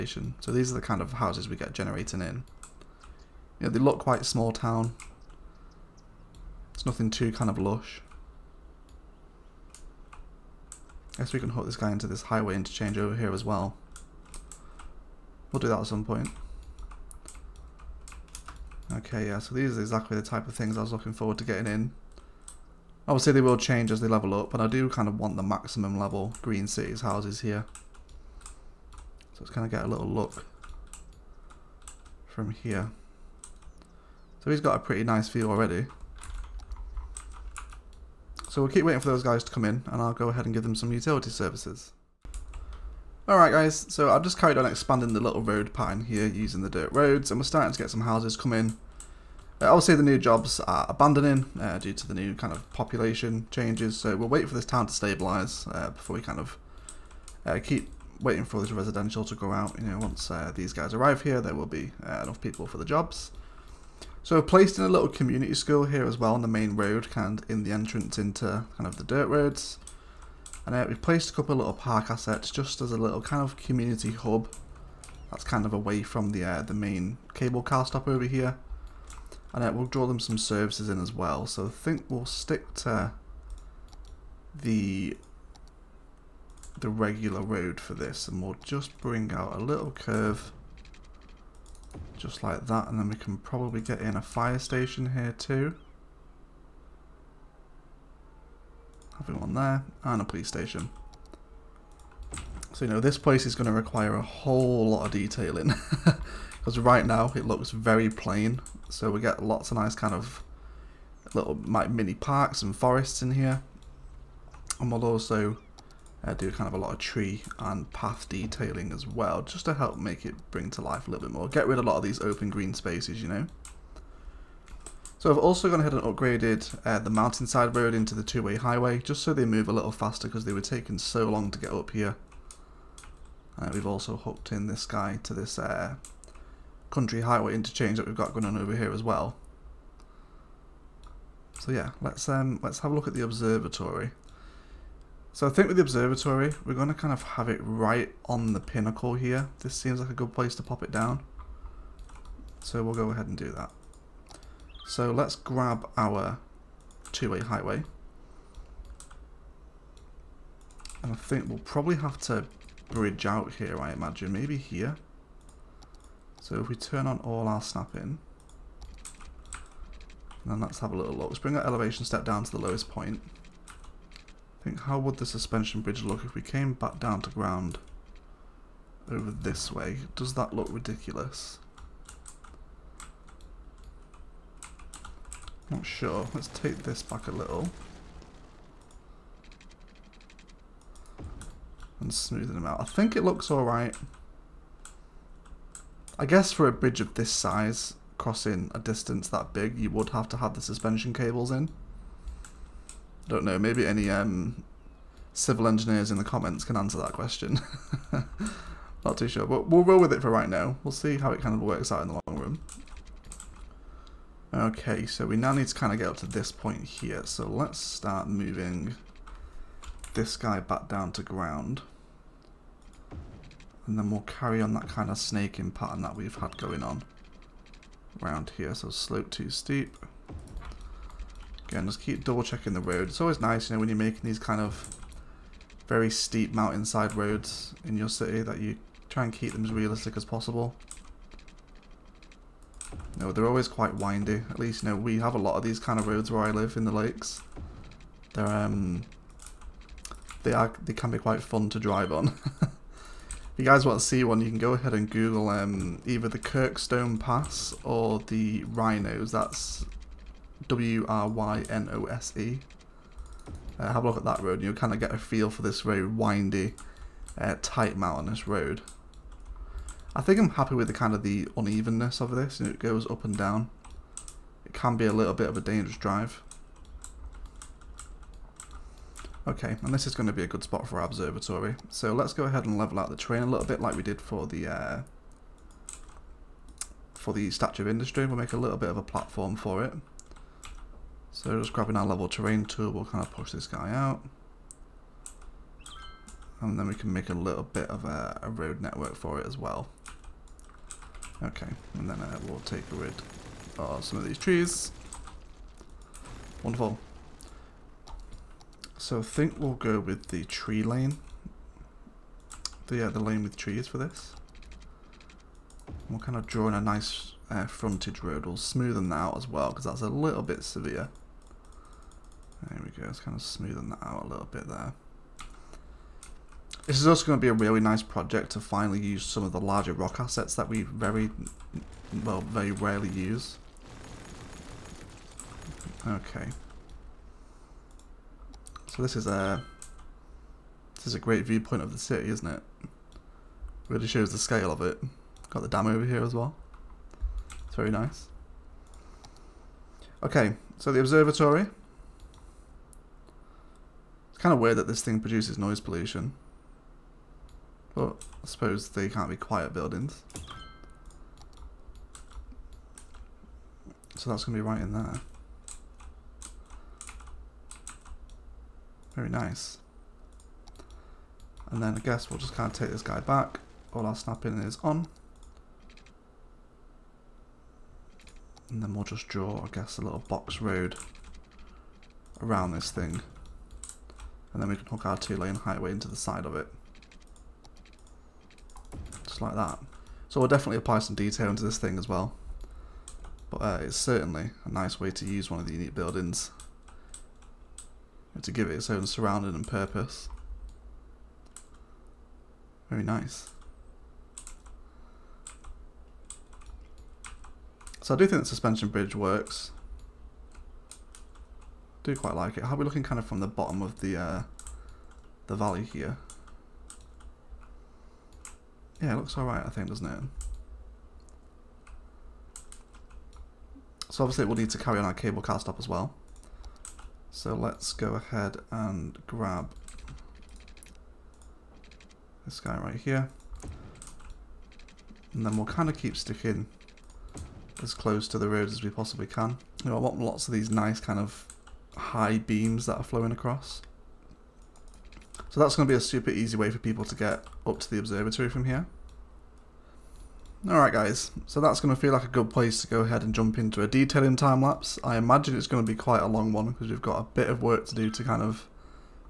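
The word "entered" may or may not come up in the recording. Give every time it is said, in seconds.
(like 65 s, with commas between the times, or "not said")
not said.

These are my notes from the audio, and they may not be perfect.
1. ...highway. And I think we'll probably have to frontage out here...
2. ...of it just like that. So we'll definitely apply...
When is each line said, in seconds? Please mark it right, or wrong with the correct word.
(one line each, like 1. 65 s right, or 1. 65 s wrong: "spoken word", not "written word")
1. 157 s wrong: "bridge", not "frontage"
2. 386 s right.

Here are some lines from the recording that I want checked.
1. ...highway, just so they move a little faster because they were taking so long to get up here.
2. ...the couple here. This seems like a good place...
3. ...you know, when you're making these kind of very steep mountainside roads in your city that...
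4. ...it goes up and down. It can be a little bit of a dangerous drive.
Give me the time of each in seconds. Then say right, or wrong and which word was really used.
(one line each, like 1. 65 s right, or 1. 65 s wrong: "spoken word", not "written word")
1. 128 s right
2. 148 s wrong: "pinnacle", not "couple"
3. 233 s right
4. 272 s right.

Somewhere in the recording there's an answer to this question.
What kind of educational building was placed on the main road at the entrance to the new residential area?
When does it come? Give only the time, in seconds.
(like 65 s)
65 s.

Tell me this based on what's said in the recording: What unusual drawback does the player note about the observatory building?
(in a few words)
Noise pollution.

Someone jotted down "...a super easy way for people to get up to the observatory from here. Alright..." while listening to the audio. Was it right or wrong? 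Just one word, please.
right.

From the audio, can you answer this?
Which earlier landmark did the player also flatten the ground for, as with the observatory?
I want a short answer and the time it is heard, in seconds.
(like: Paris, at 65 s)
Statue of Industry, at 287 s.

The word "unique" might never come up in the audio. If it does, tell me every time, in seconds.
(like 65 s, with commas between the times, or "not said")
395 s.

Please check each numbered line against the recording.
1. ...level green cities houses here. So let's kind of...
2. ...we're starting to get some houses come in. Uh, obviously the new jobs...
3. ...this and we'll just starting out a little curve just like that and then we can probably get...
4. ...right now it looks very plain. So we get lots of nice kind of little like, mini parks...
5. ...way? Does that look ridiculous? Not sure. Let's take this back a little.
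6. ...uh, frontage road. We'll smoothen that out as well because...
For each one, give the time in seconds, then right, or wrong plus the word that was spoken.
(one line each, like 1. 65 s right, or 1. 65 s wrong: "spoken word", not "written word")
1. 25 s right
2. 47 s right
3. 87 s wrong: "bring", not "starting"
4. 106 s right
5. 179 s right
6. 317 s right.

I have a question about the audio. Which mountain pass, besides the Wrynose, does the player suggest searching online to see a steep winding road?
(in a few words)
Kirkstone Pass.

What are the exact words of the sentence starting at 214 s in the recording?
Okay, so we now need to kind of get up to this point here.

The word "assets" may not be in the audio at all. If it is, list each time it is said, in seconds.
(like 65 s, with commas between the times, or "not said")
72 s, 330 s.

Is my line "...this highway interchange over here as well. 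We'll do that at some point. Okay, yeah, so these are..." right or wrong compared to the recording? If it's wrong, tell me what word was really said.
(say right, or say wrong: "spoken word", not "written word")
right.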